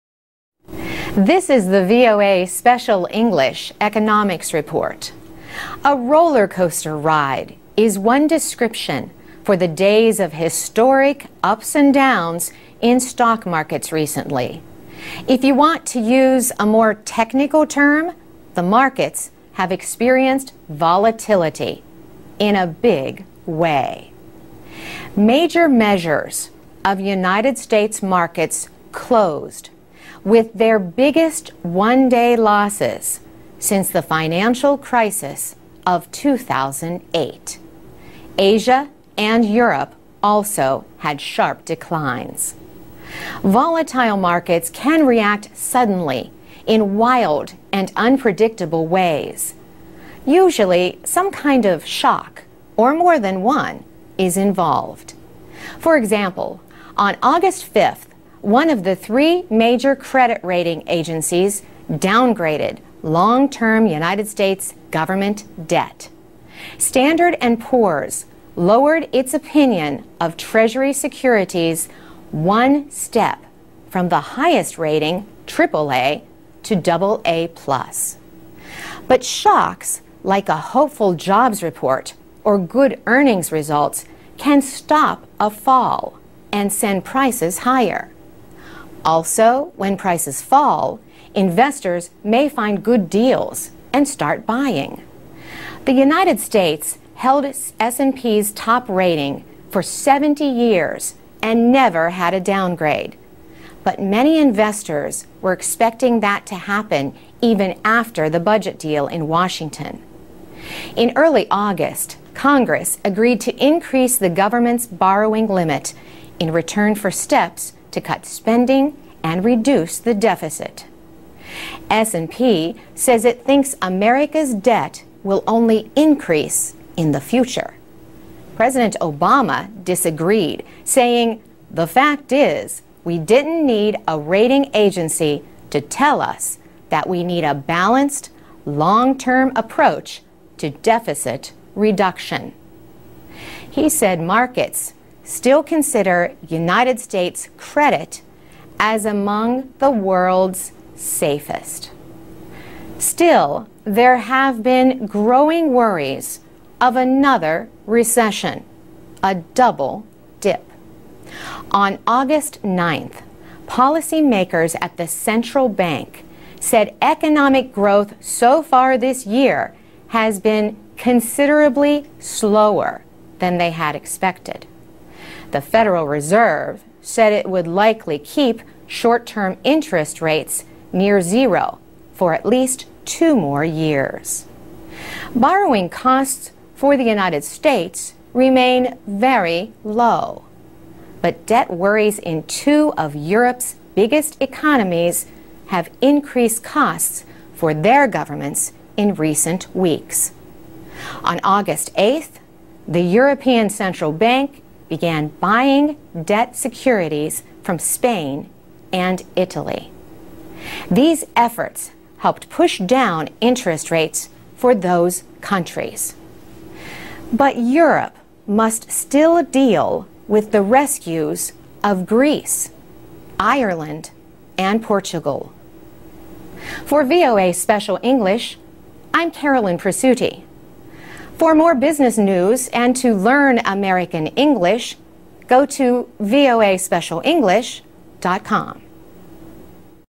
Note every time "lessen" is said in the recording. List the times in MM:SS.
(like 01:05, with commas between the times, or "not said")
not said.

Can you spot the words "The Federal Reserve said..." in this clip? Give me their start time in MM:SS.
02:55.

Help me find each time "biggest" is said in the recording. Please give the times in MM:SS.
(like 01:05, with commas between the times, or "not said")
00:30, 03:13.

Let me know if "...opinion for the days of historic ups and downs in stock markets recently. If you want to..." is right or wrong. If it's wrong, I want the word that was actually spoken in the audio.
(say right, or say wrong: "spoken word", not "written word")
wrong: "description", not "opinion".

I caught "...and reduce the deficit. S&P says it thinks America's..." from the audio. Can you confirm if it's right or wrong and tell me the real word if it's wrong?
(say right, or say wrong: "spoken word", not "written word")
right.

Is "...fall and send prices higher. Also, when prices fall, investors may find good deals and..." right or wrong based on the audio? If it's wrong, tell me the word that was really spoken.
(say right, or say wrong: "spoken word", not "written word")
right.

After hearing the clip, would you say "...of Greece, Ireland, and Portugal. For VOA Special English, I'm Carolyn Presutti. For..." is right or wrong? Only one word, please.
right.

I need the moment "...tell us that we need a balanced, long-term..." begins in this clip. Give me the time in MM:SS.
02:15.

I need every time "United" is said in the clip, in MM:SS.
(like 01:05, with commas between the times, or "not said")
00:27, 01:03, 01:35, 02:26, 03:07.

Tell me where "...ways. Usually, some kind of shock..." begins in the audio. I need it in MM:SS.
00:48.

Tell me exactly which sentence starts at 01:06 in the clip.
Standard & Poor's lowered its opinion of Treasury securities one step from the highest rating, AAA, to AA+.